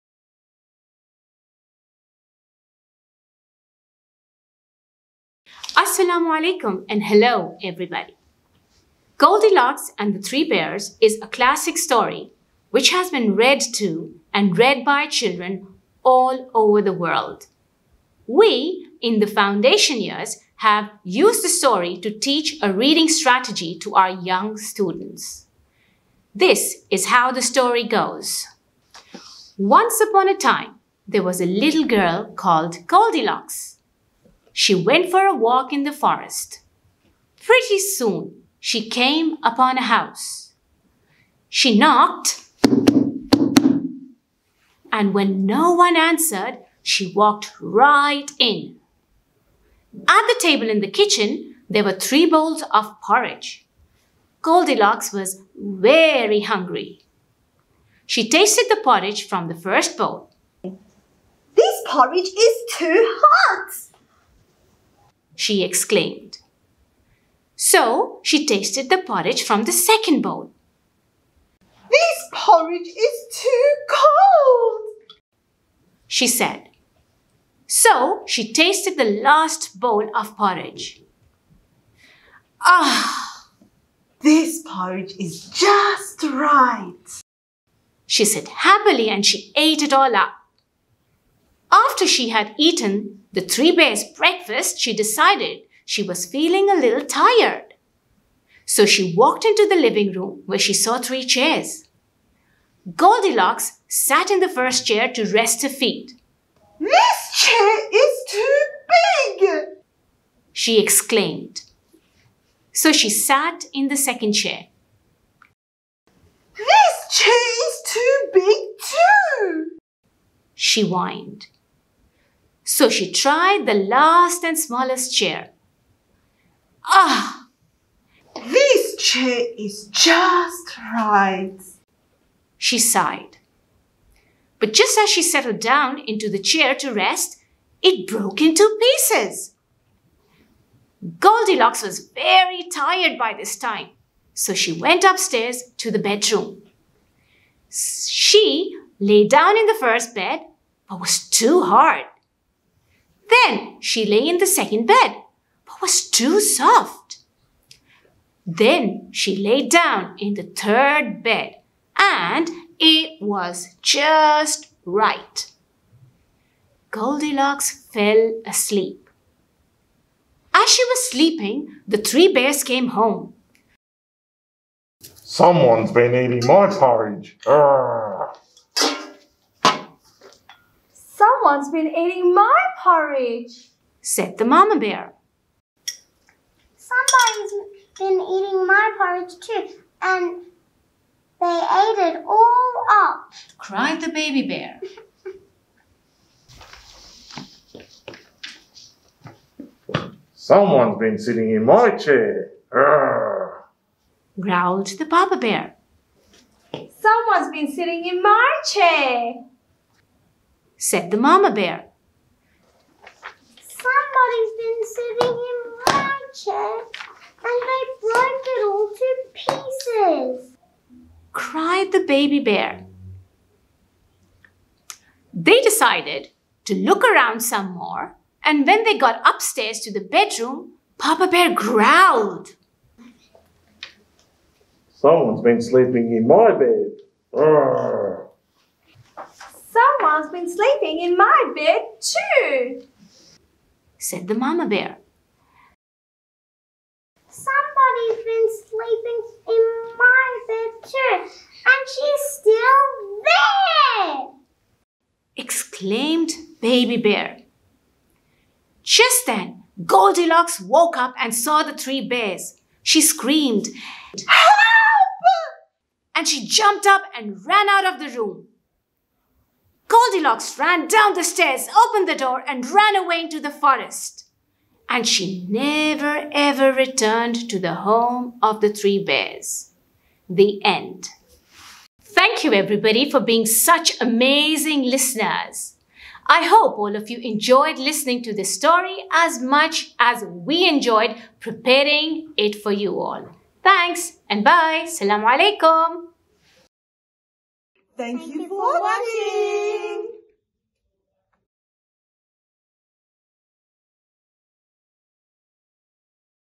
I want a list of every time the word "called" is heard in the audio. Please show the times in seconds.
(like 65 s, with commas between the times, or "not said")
32 s.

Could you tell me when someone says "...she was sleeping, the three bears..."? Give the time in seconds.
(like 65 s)
170 s.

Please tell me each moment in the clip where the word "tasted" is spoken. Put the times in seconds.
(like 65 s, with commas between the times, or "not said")
58 s, 68 s, 78 s.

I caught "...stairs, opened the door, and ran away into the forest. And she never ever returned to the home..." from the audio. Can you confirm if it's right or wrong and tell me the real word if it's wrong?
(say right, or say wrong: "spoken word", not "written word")
right.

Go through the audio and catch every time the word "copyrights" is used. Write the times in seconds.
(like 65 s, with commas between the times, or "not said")
not said.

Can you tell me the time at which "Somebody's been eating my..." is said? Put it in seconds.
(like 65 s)
186 s.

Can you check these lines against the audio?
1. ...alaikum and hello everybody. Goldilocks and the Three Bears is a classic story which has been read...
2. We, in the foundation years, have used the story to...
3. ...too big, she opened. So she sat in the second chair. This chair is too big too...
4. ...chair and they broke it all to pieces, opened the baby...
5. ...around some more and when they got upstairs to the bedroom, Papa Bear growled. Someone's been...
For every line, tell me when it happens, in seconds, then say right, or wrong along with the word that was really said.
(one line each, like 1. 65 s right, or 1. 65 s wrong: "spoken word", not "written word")
1. 6 s right
2. 18 s right
3. 108 s wrong: "exclaimed", not "opened"
4. 216 s wrong: "cried", not "opened"
5. 227 s right.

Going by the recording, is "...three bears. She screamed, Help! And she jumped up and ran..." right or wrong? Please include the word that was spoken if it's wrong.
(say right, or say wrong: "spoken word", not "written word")
right.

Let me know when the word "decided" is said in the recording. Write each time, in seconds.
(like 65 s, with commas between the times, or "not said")
94 s, 225 s.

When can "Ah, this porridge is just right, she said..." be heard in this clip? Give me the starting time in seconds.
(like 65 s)
82 s.